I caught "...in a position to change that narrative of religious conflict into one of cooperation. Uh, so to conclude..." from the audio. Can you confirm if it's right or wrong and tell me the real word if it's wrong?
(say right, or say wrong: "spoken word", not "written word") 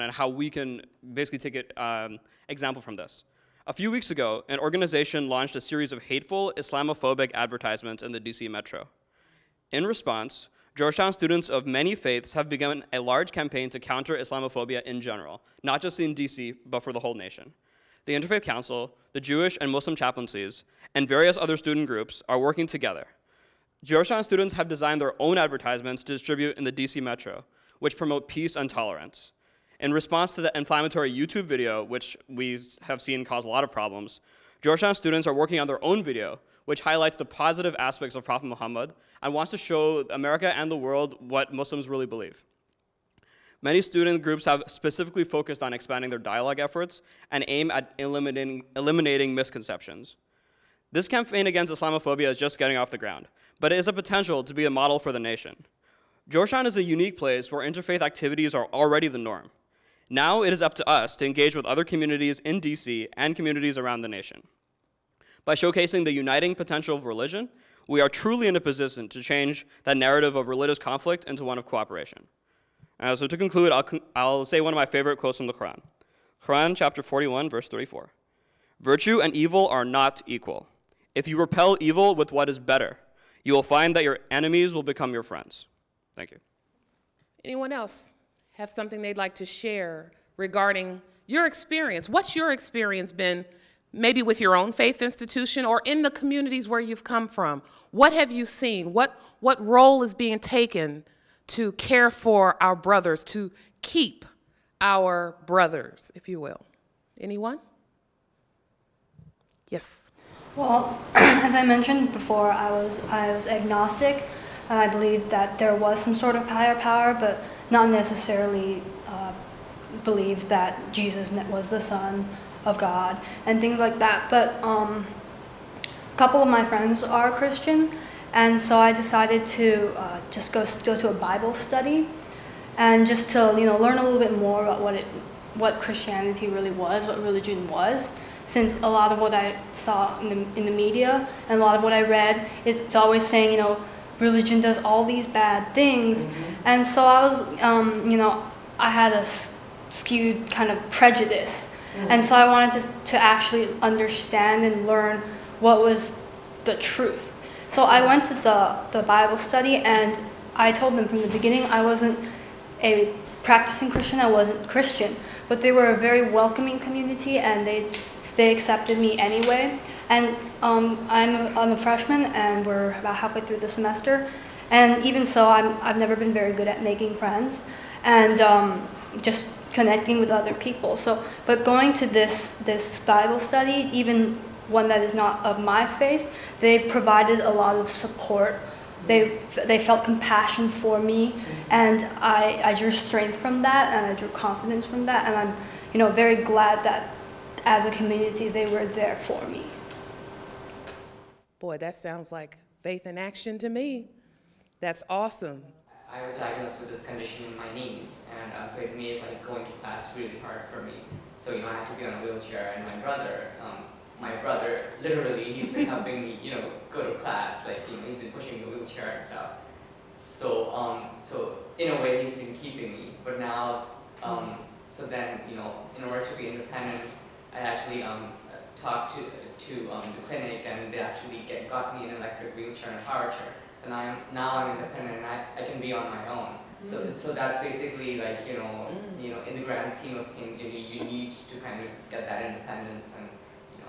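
right.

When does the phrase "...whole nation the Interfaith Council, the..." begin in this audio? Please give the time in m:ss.
0:16.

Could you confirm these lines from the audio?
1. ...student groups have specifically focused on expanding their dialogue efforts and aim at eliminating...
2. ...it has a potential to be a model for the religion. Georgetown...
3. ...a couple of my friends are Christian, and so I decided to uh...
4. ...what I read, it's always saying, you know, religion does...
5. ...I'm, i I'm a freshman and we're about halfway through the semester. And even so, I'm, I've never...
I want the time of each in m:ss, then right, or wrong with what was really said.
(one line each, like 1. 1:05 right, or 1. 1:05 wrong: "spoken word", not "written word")
1. 0:43 right
2. 0:53 wrong: "nation", not "religion"
3. 2:05 right
4. 2:21 right
5. 2:51 right.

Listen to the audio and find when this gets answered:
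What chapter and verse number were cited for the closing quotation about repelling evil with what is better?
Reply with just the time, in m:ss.
1:16.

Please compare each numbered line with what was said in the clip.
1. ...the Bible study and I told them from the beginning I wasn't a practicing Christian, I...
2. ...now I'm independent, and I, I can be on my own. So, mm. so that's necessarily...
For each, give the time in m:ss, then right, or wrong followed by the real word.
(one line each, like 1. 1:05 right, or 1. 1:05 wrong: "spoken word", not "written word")
1. 2:38 right
2. 3:54 wrong: "basically", not "necessarily".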